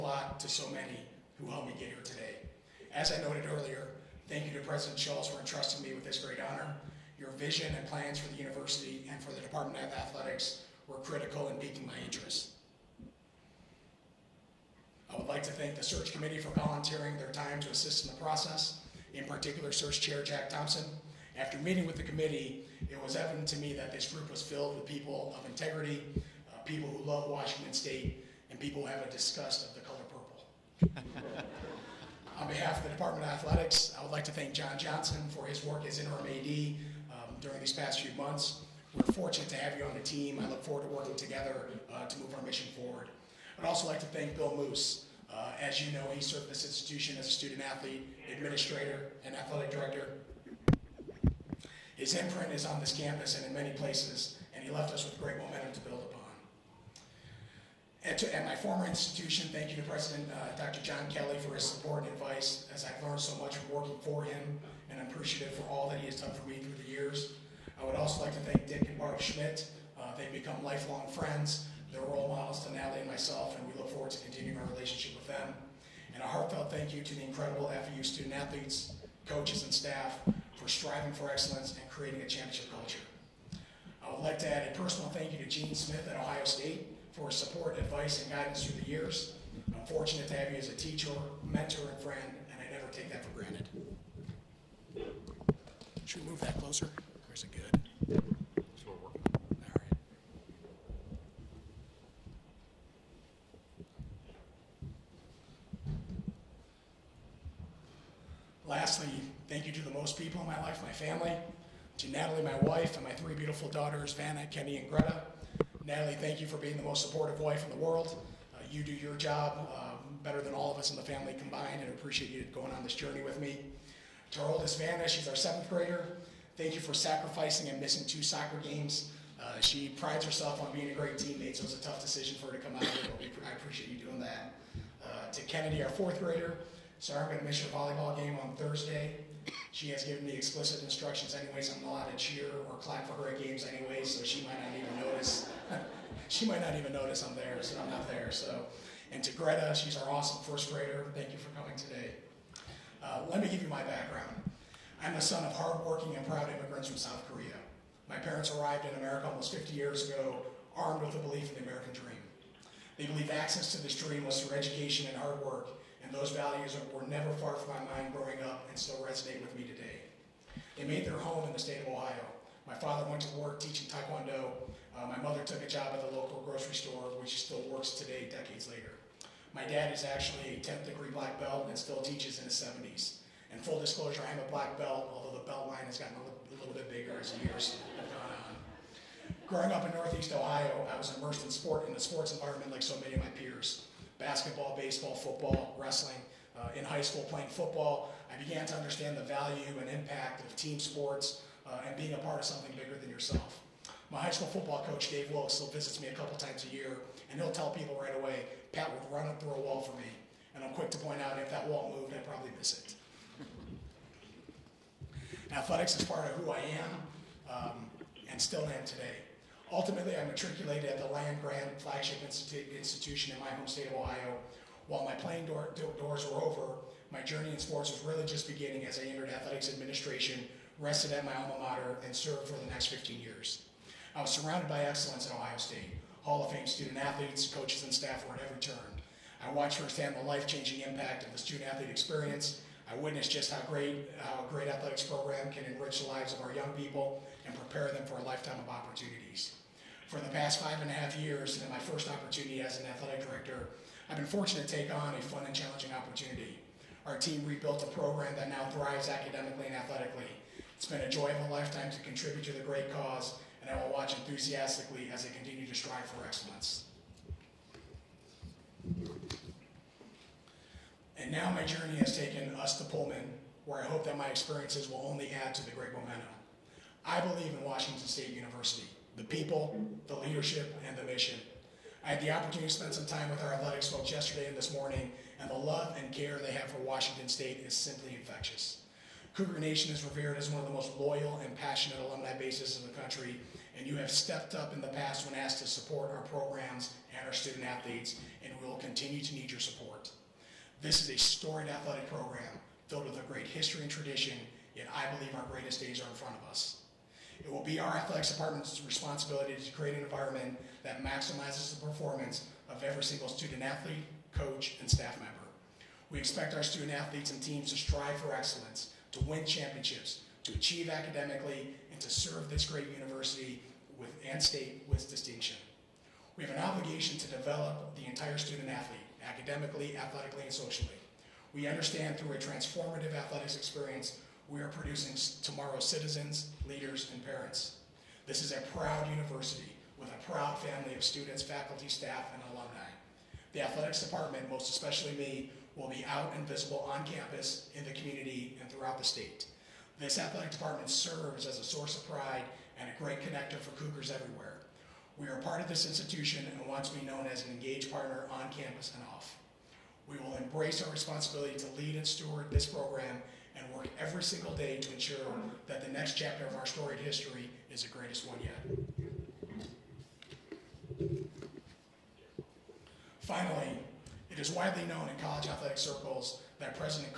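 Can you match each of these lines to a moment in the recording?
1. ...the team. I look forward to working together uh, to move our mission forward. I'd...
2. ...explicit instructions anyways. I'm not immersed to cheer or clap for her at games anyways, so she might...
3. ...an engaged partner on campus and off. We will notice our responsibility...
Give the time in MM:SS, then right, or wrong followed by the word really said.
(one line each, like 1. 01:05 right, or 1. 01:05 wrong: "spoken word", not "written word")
1. 00:39 right
2. 02:20 wrong: "allowed", not "immersed"
3. 05:57 wrong: "embrace", not "notice".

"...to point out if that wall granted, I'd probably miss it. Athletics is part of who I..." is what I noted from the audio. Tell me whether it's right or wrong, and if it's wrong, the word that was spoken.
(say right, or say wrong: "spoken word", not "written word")
wrong: "moved", not "granted".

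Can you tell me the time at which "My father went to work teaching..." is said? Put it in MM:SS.
02:52.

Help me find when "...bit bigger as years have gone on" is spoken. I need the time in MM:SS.
03:06.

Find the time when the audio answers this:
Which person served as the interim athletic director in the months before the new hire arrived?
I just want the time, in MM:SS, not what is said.
00:34.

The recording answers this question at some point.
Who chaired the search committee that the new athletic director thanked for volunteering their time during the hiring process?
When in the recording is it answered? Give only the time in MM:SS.
00:20.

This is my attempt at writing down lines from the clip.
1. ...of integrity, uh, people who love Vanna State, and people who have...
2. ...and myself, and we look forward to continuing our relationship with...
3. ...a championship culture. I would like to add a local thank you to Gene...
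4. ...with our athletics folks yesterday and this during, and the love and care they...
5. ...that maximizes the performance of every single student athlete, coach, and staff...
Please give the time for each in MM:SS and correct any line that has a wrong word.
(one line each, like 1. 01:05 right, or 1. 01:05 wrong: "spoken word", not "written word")
1. 00:25 wrong: "Washington", not "Vanna"
2. 01:13 right
3. 01:22 wrong: "personal", not "local"
4. 04:43 wrong: "morning", not "during"
5. 05:10 right.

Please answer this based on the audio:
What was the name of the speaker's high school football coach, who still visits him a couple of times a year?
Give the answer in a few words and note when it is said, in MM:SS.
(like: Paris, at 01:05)
Dave Wilkes, at 03:25.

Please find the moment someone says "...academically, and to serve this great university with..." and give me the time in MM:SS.
05:20.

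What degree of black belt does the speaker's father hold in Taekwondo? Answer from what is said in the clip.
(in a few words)
10th degree.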